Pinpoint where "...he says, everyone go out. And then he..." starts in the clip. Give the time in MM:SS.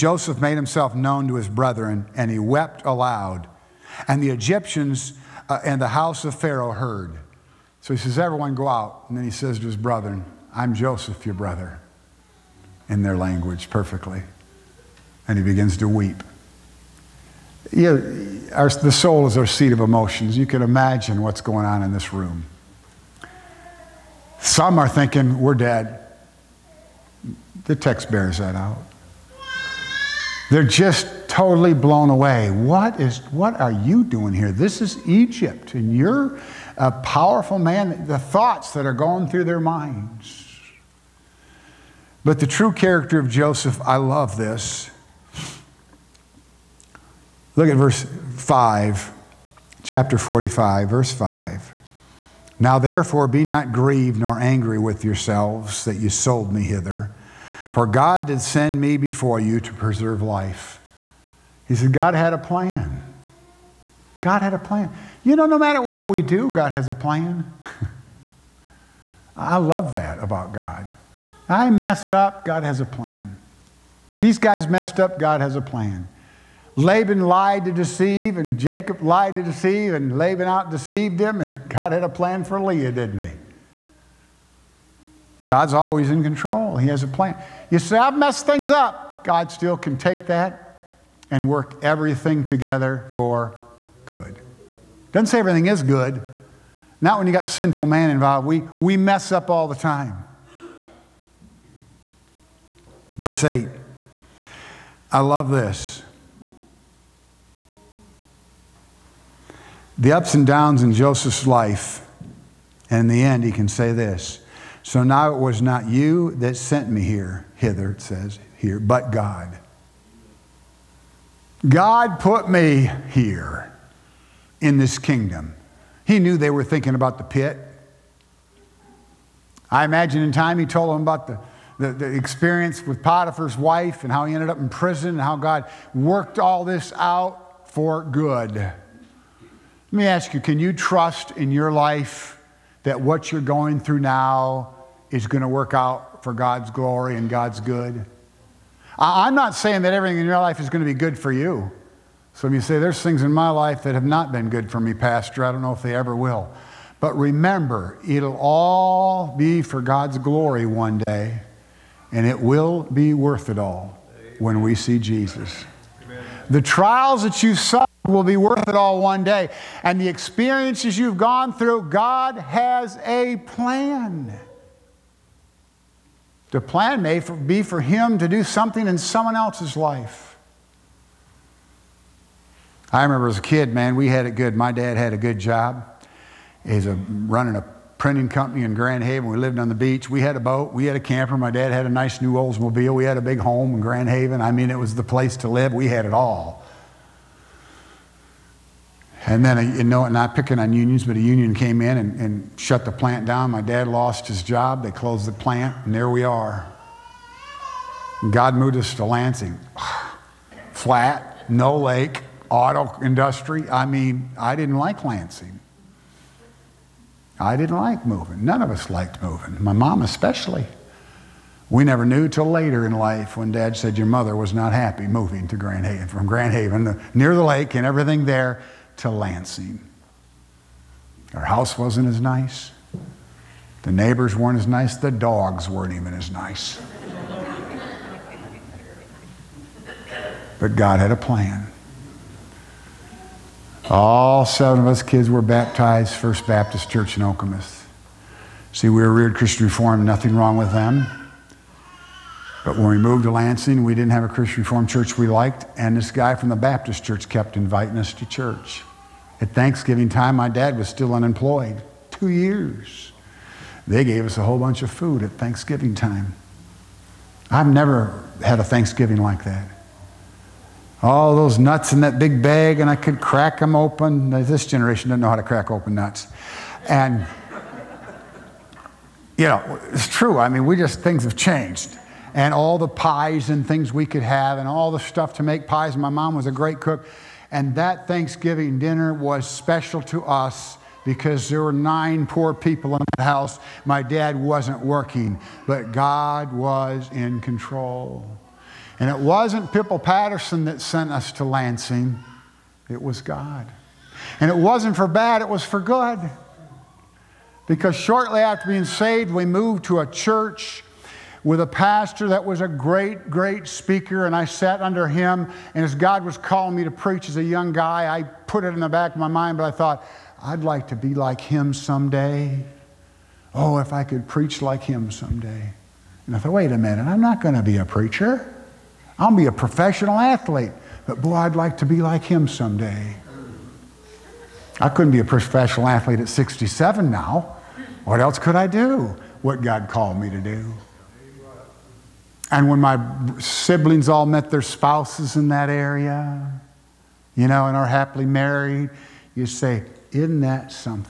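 00:07.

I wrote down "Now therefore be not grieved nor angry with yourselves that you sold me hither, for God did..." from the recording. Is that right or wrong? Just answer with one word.
right.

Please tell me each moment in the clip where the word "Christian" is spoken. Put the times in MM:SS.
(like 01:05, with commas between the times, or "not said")
04:09, 04:14.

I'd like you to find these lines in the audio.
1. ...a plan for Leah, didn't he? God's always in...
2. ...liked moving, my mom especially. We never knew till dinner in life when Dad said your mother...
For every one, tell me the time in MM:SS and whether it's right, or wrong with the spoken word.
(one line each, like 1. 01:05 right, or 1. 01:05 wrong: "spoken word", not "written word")
1. 01:22 right
2. 03:38 wrong: "later", not "dinner".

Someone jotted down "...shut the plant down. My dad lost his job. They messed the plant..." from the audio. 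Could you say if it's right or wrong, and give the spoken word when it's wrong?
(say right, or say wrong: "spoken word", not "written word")
wrong: "closed", not "messed".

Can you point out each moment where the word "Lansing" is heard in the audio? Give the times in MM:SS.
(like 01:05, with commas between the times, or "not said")
03:29, 03:35, 03:49, 04:13, 05:01.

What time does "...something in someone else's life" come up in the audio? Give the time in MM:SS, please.
02:58.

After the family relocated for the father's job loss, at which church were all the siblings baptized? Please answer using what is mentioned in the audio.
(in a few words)
First Baptist Church in Okemos.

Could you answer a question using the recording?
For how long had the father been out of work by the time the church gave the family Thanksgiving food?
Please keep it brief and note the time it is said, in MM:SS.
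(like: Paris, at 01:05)
2 years, at 04:22.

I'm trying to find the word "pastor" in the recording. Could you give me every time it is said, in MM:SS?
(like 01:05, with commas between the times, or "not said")
02:34, 05:11.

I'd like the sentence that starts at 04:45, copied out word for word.
My mom was a great cook.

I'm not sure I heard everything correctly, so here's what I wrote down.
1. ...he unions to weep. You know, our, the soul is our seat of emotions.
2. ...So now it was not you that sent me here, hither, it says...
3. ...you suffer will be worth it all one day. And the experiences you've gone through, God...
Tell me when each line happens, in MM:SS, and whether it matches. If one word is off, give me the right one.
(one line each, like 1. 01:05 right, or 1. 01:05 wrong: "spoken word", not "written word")
1. 00:15 wrong: "begins", not "unions"
2. 01:54 right
3. 02:47 right.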